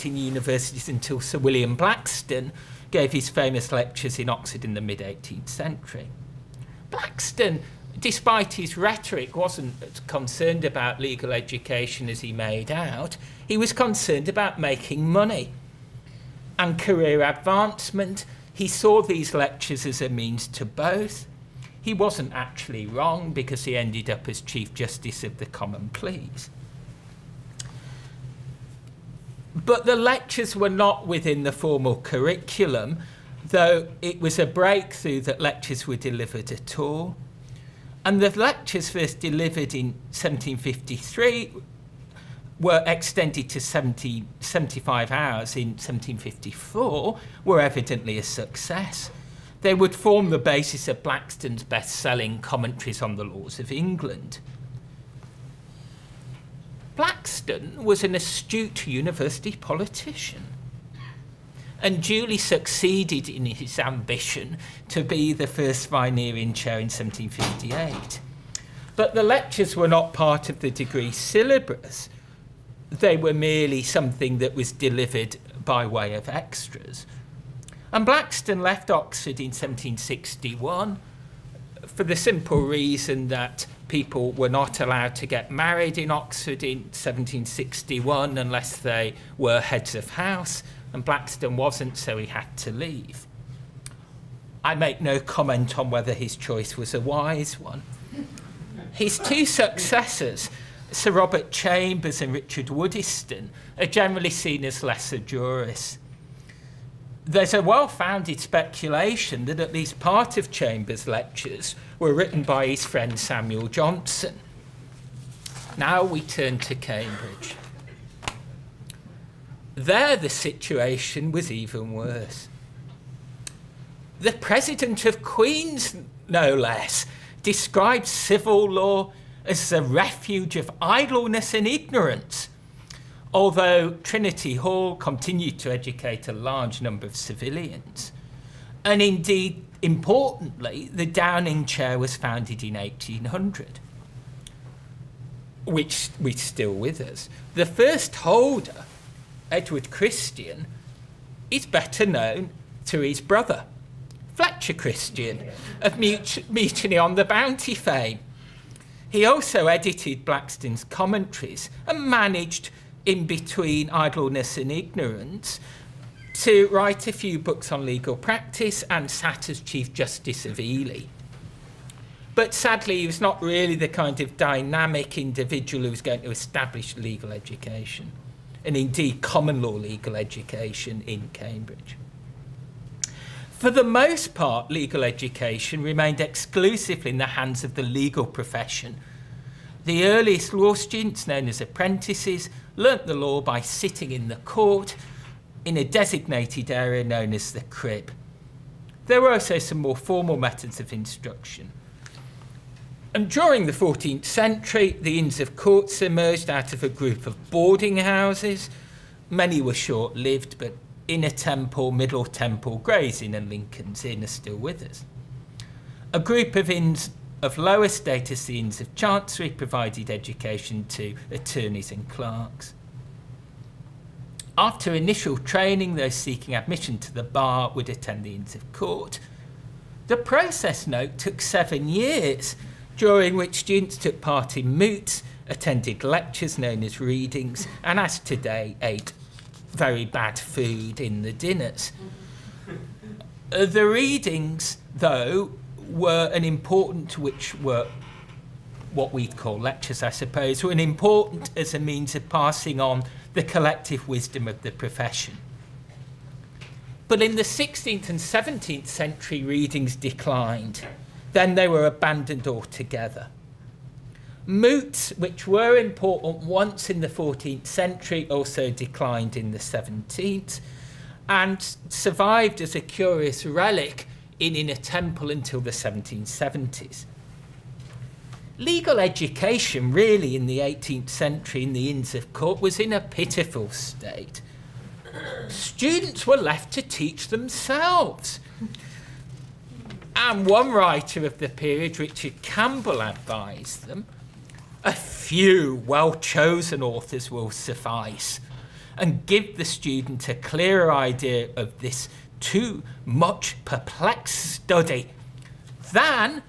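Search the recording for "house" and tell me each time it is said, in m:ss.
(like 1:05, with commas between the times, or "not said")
1:30, 3:27.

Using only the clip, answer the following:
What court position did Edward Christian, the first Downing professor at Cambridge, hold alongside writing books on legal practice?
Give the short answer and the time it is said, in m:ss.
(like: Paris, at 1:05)
Chief Justice of Ely, at 2:49.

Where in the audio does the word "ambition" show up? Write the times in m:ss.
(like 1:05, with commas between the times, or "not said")
1:03.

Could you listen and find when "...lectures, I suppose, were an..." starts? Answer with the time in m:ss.
4:09.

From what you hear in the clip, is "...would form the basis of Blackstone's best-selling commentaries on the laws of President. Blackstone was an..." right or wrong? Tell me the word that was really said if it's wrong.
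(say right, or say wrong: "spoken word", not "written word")
wrong: "England", not "President".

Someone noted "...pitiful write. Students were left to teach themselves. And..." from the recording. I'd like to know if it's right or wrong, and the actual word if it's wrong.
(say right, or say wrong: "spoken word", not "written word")
wrong: "state", not "write".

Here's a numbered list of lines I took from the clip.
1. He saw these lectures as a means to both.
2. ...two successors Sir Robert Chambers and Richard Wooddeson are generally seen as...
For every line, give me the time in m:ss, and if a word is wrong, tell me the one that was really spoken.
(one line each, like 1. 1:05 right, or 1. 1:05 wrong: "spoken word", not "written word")
1. 0:18 right
2. 1:39 right.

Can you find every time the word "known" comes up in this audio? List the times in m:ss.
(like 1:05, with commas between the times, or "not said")
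2:32, 3:11, 3:17, 3:56.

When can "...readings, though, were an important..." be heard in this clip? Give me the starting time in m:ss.
4:03.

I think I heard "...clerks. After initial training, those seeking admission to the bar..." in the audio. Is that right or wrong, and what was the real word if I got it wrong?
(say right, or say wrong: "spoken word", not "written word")
right.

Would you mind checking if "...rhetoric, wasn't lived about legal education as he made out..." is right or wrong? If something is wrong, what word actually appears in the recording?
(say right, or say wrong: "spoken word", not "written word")
wrong: "concerned", not "lived".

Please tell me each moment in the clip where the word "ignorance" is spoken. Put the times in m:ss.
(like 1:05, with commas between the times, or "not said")
2:11, 2:44.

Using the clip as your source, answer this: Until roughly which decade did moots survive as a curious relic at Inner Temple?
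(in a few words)
1770s.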